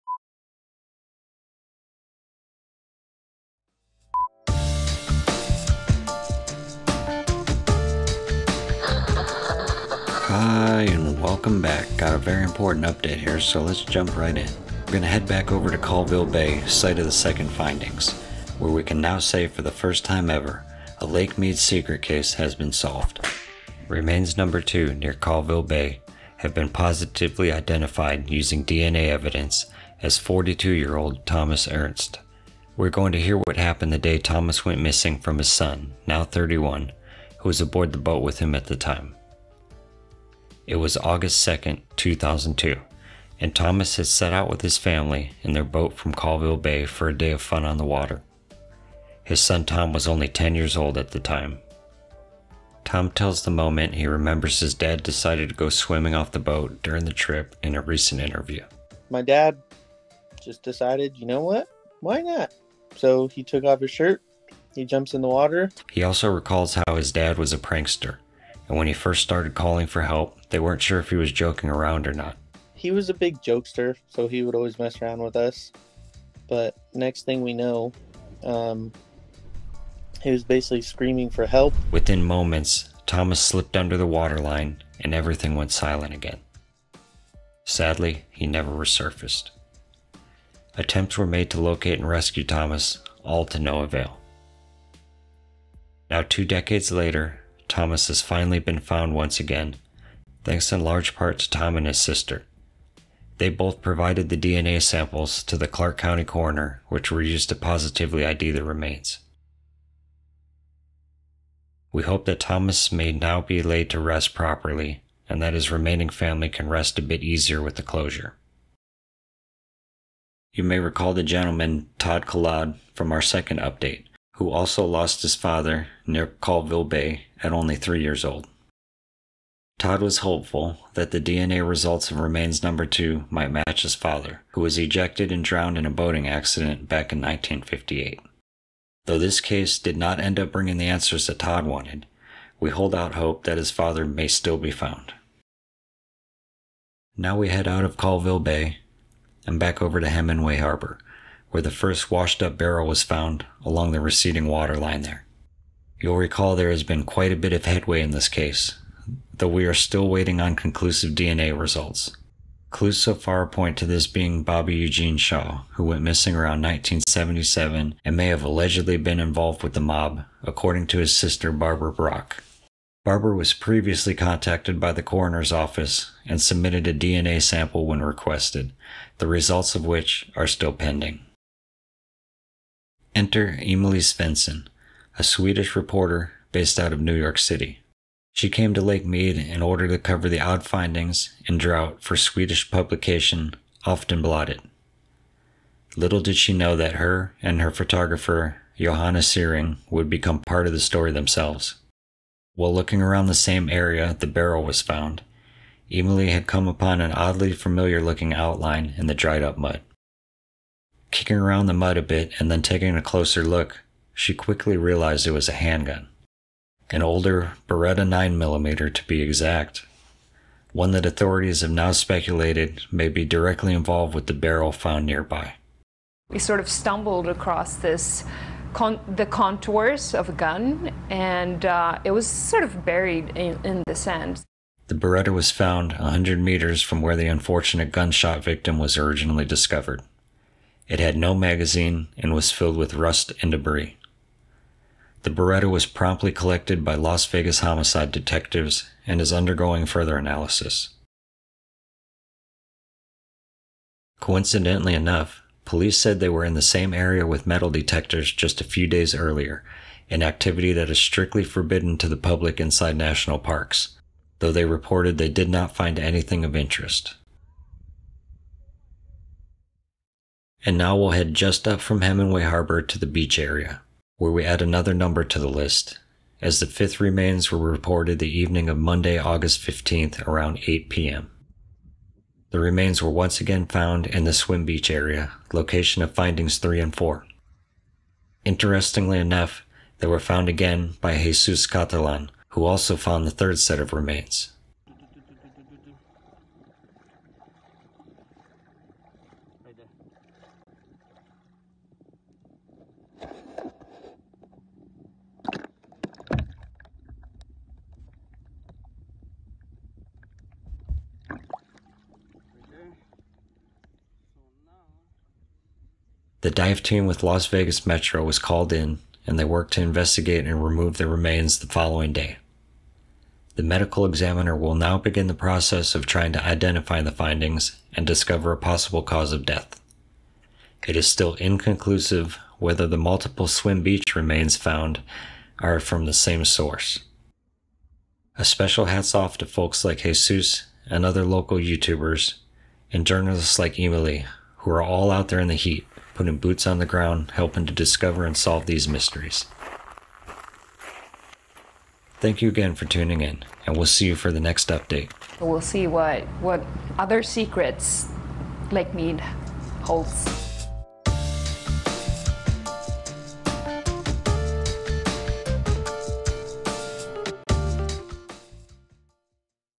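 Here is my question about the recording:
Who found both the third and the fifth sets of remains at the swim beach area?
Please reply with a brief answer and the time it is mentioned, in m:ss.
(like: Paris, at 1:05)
Jesus Catalan, at 4:51.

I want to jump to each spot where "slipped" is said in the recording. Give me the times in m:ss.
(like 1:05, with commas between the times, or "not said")
1:23.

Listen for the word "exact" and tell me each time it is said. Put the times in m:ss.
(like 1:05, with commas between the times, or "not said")
3:39.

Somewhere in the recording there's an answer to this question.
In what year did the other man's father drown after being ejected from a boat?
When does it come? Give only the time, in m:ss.
2:17.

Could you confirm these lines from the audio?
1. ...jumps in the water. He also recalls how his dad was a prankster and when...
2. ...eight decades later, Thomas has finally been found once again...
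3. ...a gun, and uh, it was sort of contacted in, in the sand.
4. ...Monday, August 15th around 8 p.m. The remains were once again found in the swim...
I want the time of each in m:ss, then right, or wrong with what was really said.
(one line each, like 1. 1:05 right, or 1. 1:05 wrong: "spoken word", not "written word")
1. 1:04 right
2. 1:36 wrong: "two", not "eight"
3. 3:50 wrong: "buried", not "contacted"
4. 4:38 right.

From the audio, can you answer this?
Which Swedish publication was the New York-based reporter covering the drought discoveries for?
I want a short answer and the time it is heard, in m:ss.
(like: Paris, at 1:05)
Aftonbladet, at 3:13.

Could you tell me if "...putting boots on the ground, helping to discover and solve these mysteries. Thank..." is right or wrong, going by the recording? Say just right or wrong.
right.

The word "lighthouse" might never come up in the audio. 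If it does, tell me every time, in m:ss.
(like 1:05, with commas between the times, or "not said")
not said.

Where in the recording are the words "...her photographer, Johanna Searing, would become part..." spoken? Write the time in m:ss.
3:17.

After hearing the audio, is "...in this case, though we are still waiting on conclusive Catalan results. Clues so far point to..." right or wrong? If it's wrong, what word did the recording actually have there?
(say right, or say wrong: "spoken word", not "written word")
wrong: "DNA", not "Catalan".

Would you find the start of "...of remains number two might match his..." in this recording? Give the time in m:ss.
2:12.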